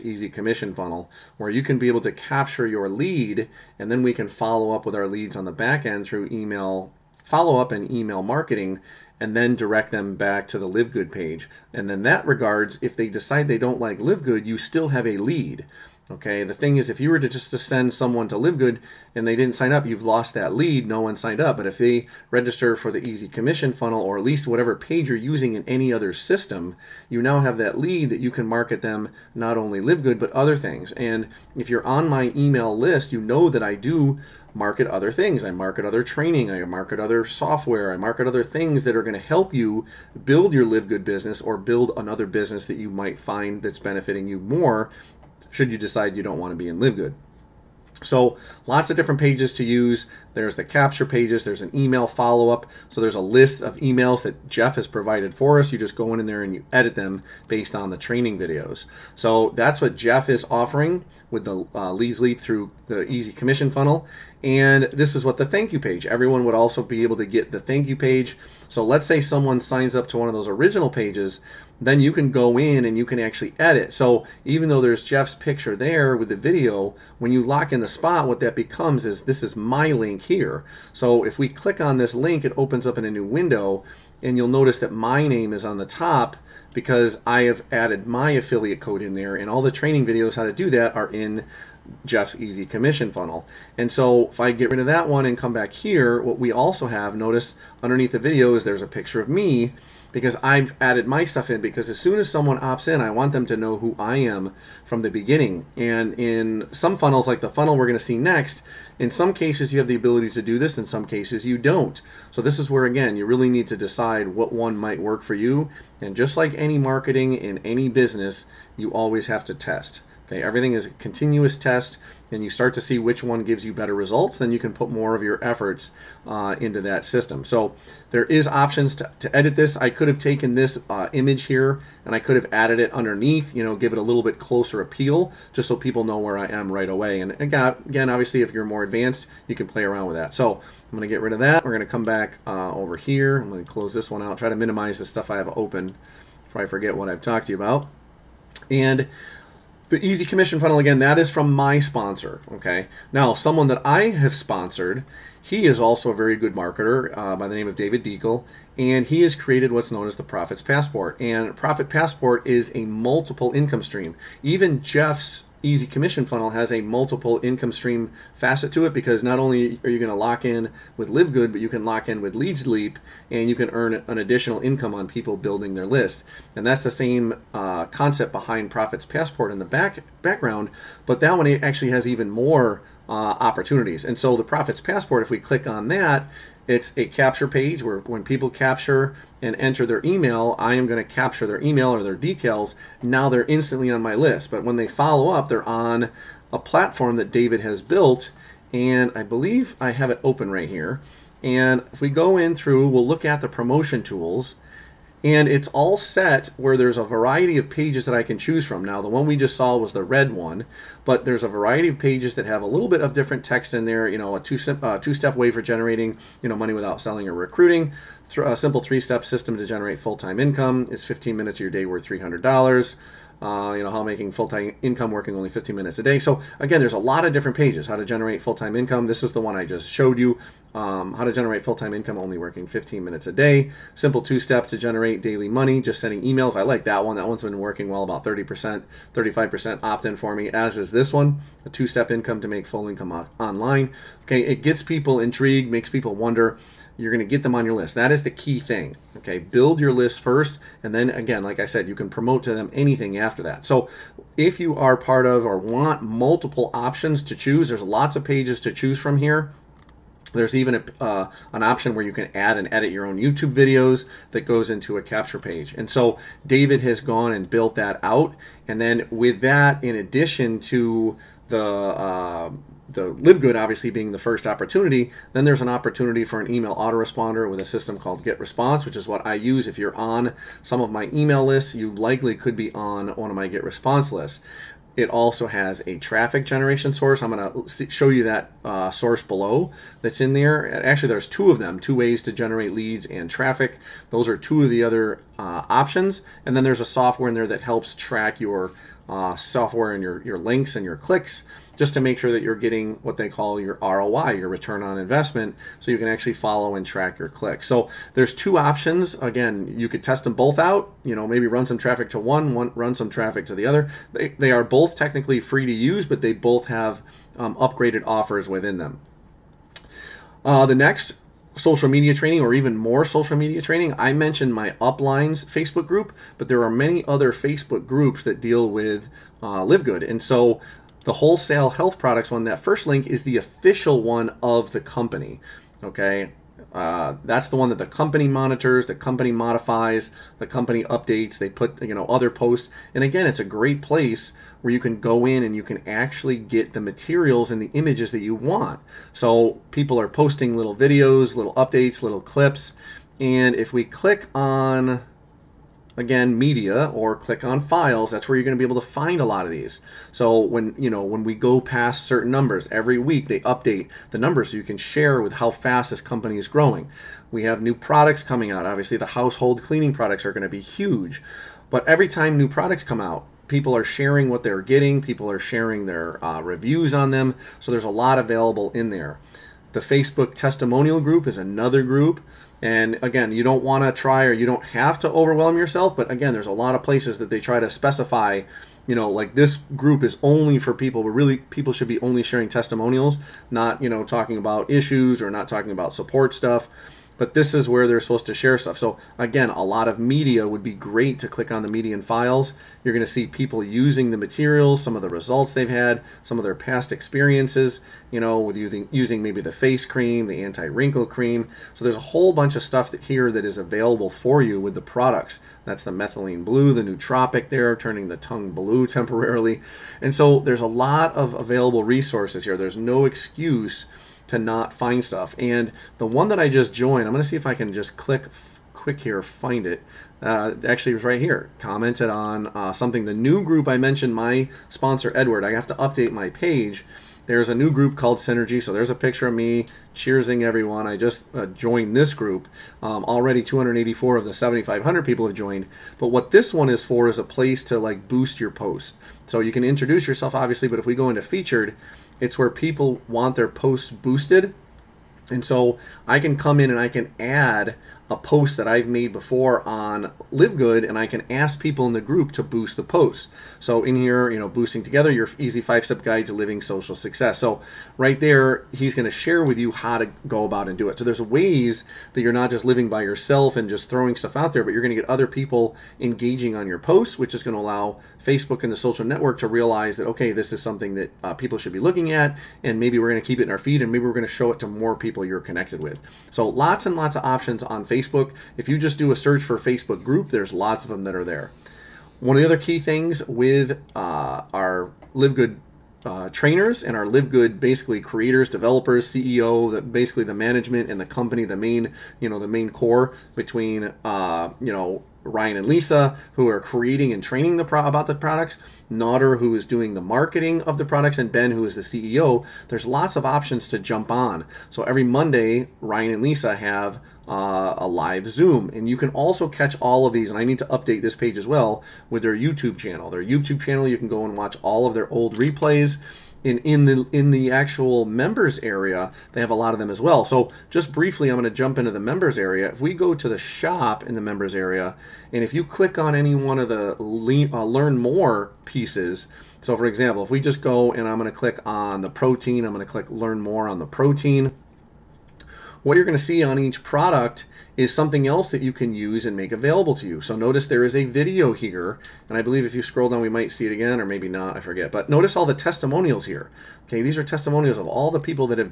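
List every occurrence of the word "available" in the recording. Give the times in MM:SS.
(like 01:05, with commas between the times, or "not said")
06:18, 06:53, 07:01, 09:09.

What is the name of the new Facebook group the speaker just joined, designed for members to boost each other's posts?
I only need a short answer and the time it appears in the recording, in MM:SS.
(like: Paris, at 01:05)
Synergy, at 07:18.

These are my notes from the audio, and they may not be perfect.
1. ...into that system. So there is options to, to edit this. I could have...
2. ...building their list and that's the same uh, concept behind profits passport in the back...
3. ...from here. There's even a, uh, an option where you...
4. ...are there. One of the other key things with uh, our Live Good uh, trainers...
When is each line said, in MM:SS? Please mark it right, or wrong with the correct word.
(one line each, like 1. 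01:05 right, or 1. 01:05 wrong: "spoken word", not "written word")
1. 02:06 right
2. 02:55 right
3. 04:18 right
4. 08:11 right.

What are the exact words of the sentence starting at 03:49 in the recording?
This is the one I just showed you, um, how to generate full-time income only working 15 minutes a day.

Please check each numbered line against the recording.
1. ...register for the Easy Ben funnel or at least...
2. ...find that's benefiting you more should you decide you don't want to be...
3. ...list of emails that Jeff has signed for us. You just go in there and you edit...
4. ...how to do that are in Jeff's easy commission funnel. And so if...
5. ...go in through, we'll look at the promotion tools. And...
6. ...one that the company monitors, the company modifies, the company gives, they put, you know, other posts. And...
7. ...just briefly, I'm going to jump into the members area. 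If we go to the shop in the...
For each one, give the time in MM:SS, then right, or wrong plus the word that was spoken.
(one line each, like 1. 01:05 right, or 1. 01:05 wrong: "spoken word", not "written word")
1. 00:22 wrong: "Commission", not "Ben"
2. 00:43 right
3. 00:53 wrong: "provided", not "signed"
4. 01:30 right
5. 03:22 right
6. 05:37 wrong: "updates", not "gives"
7. 08:50 right.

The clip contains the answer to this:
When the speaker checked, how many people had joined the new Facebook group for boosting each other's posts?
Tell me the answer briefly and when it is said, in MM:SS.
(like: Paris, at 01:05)
284, at 07:23.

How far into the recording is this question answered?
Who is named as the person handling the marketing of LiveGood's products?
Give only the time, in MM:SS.
08:28.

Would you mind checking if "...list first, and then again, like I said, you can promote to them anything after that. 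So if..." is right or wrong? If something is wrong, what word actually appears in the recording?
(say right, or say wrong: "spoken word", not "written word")
right.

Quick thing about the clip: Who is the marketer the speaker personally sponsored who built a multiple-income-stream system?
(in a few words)
David Deagle.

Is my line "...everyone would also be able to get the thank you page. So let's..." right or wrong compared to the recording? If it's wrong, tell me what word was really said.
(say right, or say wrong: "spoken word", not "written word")
right.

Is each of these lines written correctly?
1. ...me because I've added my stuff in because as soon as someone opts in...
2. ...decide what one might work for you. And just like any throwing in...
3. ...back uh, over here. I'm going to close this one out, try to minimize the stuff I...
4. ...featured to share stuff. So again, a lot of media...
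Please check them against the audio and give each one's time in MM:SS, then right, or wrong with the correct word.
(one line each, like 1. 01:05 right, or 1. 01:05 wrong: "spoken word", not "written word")
1. 01:39 right
2. 01:53 wrong: "marketing", not "throwing"
3. 02:22 right
4. 06:37 wrong: "supposed", not "featured".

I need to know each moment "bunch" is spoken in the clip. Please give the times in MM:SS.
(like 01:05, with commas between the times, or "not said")
06:52.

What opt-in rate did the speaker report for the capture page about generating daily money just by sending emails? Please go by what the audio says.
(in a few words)
30-35%.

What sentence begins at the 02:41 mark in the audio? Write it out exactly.
And Profit Passport is a multiple income stream.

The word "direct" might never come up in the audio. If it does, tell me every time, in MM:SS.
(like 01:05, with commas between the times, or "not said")
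00:09.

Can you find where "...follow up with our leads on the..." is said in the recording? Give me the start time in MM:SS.
00:04.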